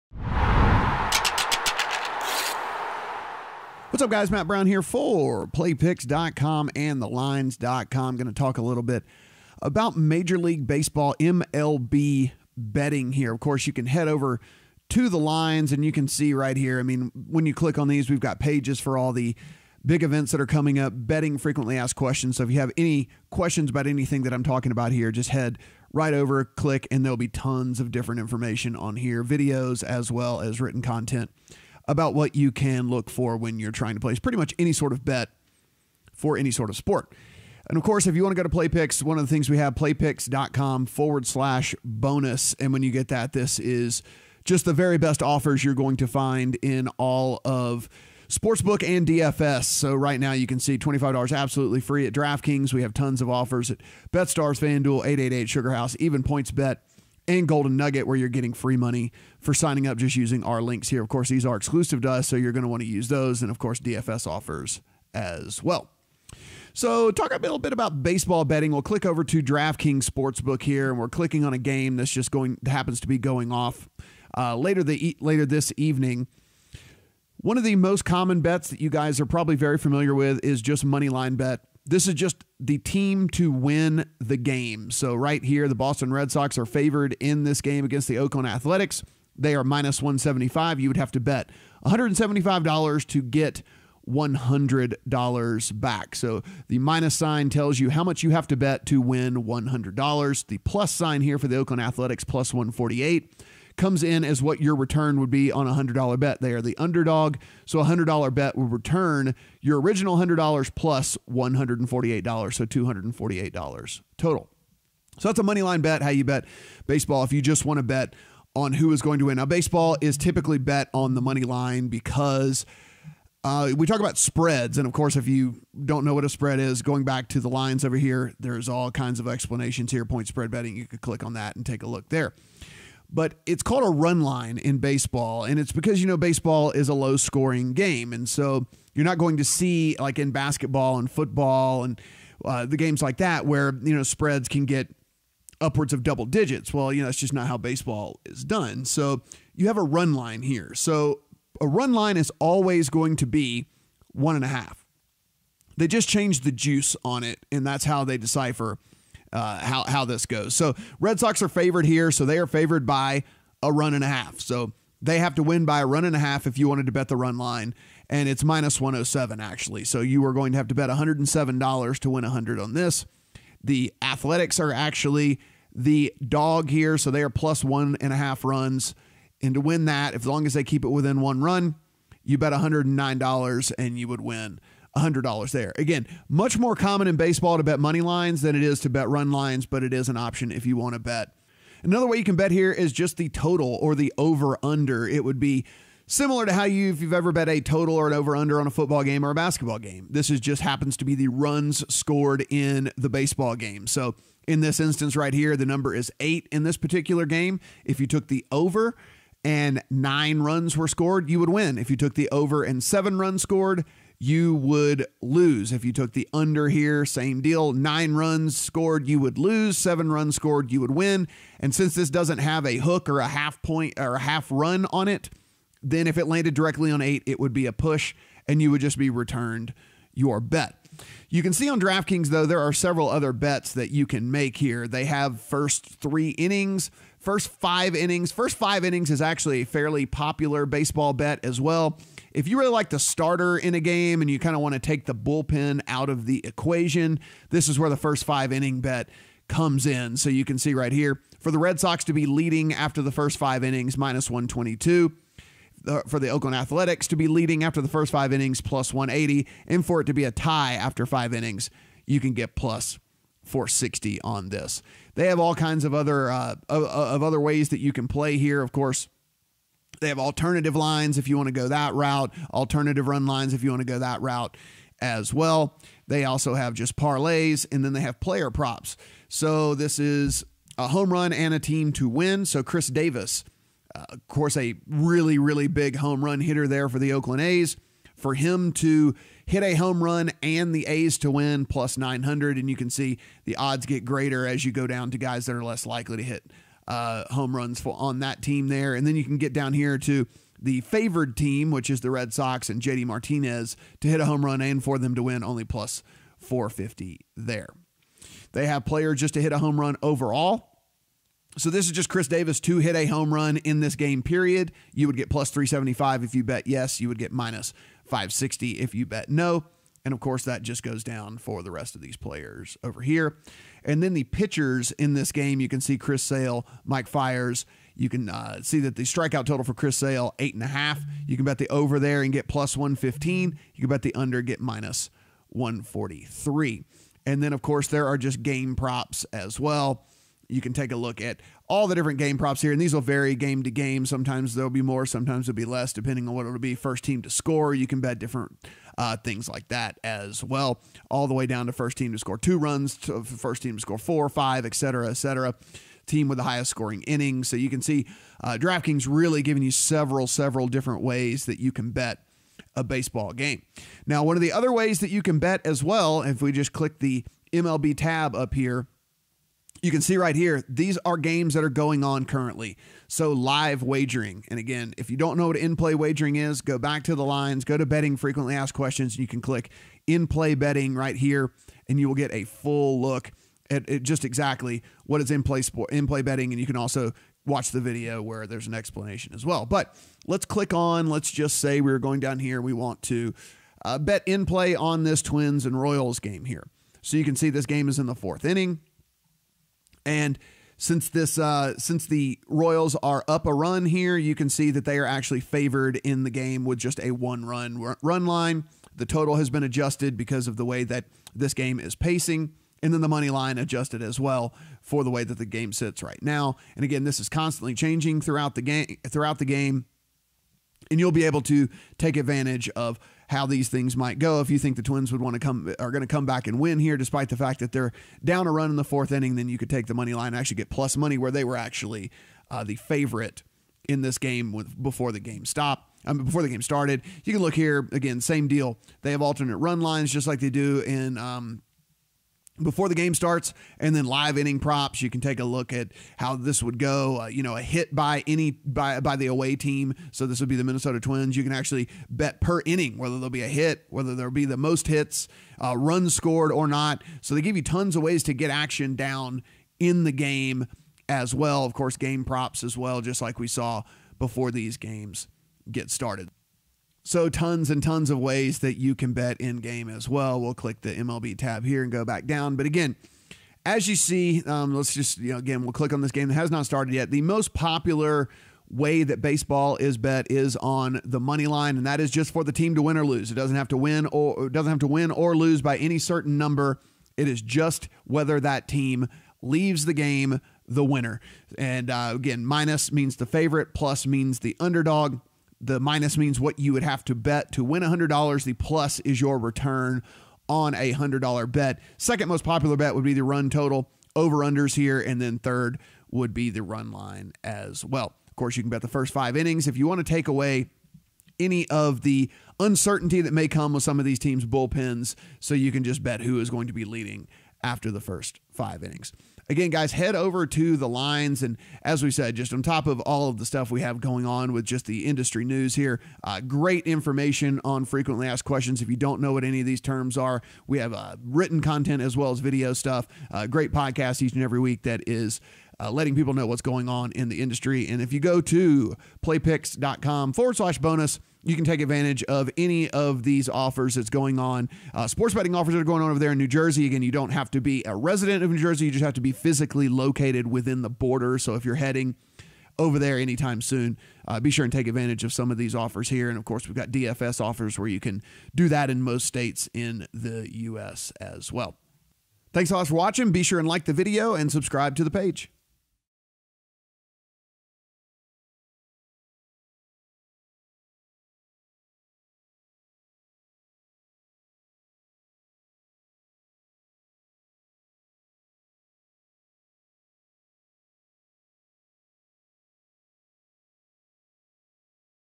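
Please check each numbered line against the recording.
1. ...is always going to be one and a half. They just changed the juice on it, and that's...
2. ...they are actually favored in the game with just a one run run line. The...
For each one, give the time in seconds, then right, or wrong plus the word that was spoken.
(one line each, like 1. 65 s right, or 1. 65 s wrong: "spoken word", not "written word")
1. 152 s right
2. 404 s right.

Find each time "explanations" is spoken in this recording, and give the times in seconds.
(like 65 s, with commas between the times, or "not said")
129 s, 388 s.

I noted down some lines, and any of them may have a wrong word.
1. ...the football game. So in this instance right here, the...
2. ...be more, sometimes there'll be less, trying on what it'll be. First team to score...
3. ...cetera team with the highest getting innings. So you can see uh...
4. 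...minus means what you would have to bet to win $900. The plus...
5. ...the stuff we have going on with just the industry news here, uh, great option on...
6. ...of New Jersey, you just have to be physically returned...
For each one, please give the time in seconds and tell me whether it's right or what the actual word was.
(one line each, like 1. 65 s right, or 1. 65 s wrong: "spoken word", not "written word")
1. 202 s wrong: "baseball", not "football"
2. 344 s wrong: "depending", not "trying"
3. 355 s wrong: "scoring", not "getting"
4. 495 s wrong: "100", not "900"
5. 523 s wrong: "information", not "option"
6. 548 s wrong: "located", not "returned".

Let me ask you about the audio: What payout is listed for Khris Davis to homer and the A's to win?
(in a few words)
+900.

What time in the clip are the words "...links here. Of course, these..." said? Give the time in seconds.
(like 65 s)
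60 s.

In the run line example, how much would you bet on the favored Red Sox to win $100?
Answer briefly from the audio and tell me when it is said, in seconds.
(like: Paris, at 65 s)
$107, at 168 s.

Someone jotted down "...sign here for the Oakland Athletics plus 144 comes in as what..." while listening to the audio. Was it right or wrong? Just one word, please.
wrong.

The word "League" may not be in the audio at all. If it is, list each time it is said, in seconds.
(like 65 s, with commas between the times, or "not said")
10 s.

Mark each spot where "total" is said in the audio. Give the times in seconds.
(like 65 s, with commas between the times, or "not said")
114 s, 193 s, 197 s, 329 s, 409 s, 503 s.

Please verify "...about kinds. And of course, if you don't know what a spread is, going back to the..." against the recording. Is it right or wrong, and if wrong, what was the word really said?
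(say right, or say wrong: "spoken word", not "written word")
wrong: "spreads", not "kinds".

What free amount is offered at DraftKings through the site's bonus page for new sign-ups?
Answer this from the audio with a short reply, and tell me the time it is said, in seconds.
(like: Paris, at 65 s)
$25, at 50 s.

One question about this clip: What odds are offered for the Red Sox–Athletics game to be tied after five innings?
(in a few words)
+460.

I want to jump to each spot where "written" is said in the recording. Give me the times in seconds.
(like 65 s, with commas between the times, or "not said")
30 s, 531 s.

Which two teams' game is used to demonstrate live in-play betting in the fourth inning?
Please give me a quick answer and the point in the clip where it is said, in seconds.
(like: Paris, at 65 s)
Twins and Royals, at 395 s.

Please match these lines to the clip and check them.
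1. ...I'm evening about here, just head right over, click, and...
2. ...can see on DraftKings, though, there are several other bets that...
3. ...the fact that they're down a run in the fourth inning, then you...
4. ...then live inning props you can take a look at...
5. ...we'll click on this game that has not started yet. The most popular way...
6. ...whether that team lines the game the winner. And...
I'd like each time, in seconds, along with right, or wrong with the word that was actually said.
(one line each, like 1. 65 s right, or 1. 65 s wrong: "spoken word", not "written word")
1. 24 s wrong: "talking", not "evening"
2. 231 s right
3. 427 s right
4. 443 s right
5. 475 s right
6. 488 s wrong: "leaves", not "lines".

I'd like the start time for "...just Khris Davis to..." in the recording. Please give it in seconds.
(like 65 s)
311 s.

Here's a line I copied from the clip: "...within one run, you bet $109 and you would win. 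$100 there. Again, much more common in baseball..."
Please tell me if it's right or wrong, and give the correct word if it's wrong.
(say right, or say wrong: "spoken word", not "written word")
right.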